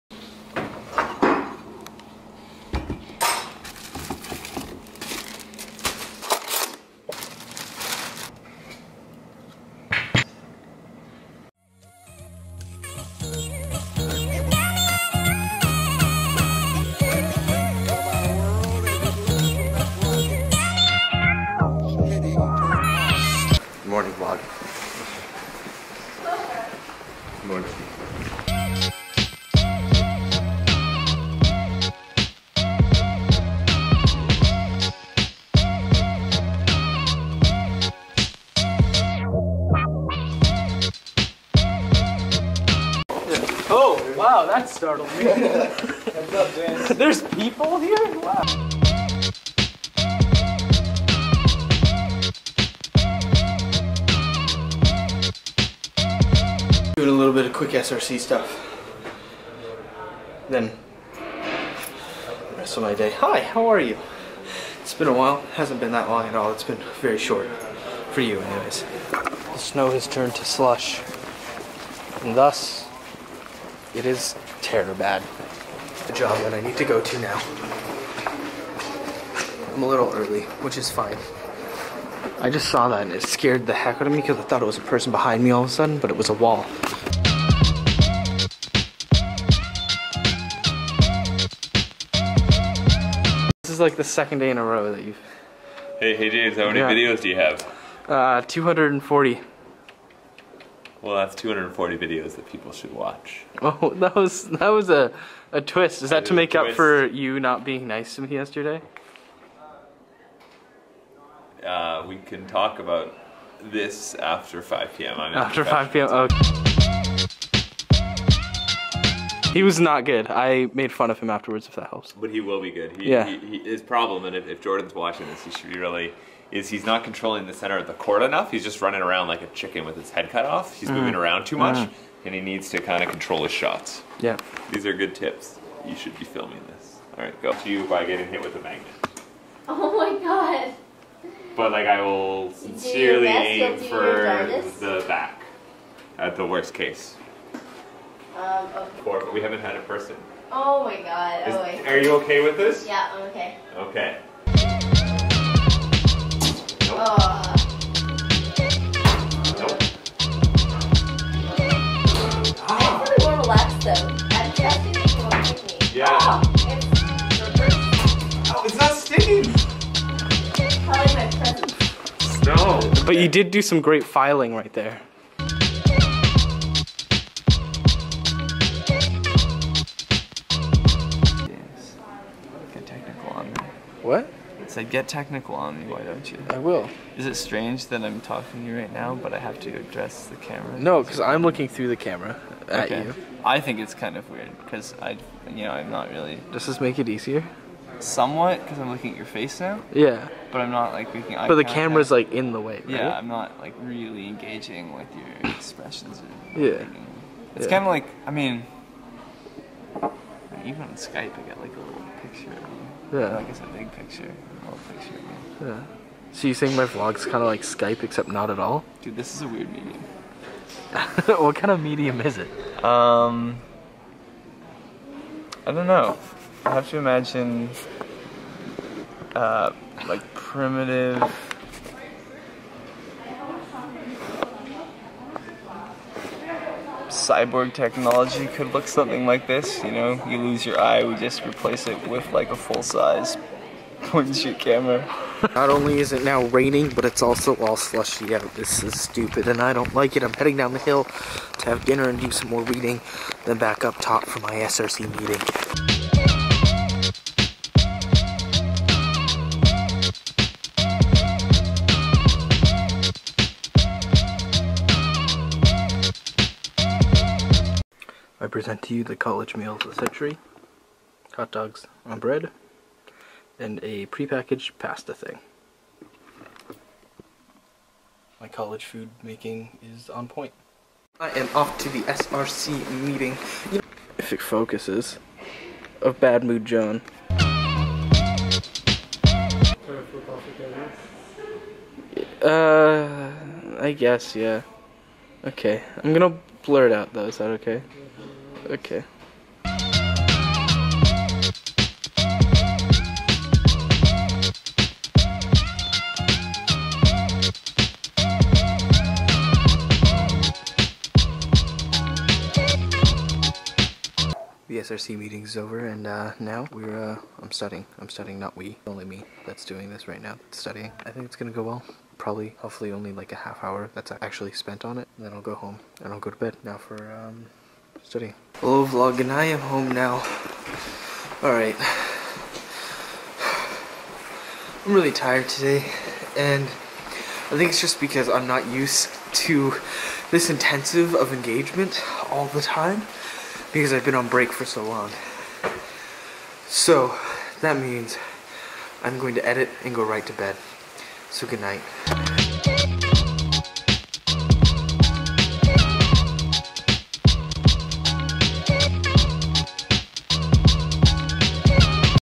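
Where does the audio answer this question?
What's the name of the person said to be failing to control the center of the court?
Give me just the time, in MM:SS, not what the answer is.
02:04.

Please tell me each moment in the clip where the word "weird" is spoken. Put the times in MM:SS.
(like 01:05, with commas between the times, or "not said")
03:14, 03:39.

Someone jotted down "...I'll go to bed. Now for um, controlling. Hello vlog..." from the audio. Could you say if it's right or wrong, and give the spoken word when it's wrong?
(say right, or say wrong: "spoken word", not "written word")
wrong: "studying", not "controlling".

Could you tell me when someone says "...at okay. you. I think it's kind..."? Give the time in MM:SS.
03:12.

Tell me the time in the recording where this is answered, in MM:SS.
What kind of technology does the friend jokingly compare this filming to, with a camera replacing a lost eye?
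03:57.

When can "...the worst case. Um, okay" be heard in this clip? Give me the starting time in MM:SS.
02:26.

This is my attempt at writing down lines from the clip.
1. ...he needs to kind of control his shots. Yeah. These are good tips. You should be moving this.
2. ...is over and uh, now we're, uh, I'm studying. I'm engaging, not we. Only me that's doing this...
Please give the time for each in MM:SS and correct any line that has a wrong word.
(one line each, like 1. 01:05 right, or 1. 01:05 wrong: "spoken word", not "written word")
1. 02:12 wrong: "filming", not "moving"
2. 05:15 wrong: "studying", not "engaging".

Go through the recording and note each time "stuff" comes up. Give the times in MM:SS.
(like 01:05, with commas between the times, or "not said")
00:58.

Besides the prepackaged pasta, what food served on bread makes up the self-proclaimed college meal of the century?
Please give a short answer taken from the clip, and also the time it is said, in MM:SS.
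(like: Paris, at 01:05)
Hot dogs, at 04:31.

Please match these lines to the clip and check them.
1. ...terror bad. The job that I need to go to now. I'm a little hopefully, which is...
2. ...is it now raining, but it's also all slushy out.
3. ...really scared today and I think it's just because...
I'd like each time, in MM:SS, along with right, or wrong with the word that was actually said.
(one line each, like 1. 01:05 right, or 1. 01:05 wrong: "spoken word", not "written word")
1. 01:14 wrong: "early", not "hopefully"
2. 04:05 right
3. 05:34 wrong: "tired", not "scared".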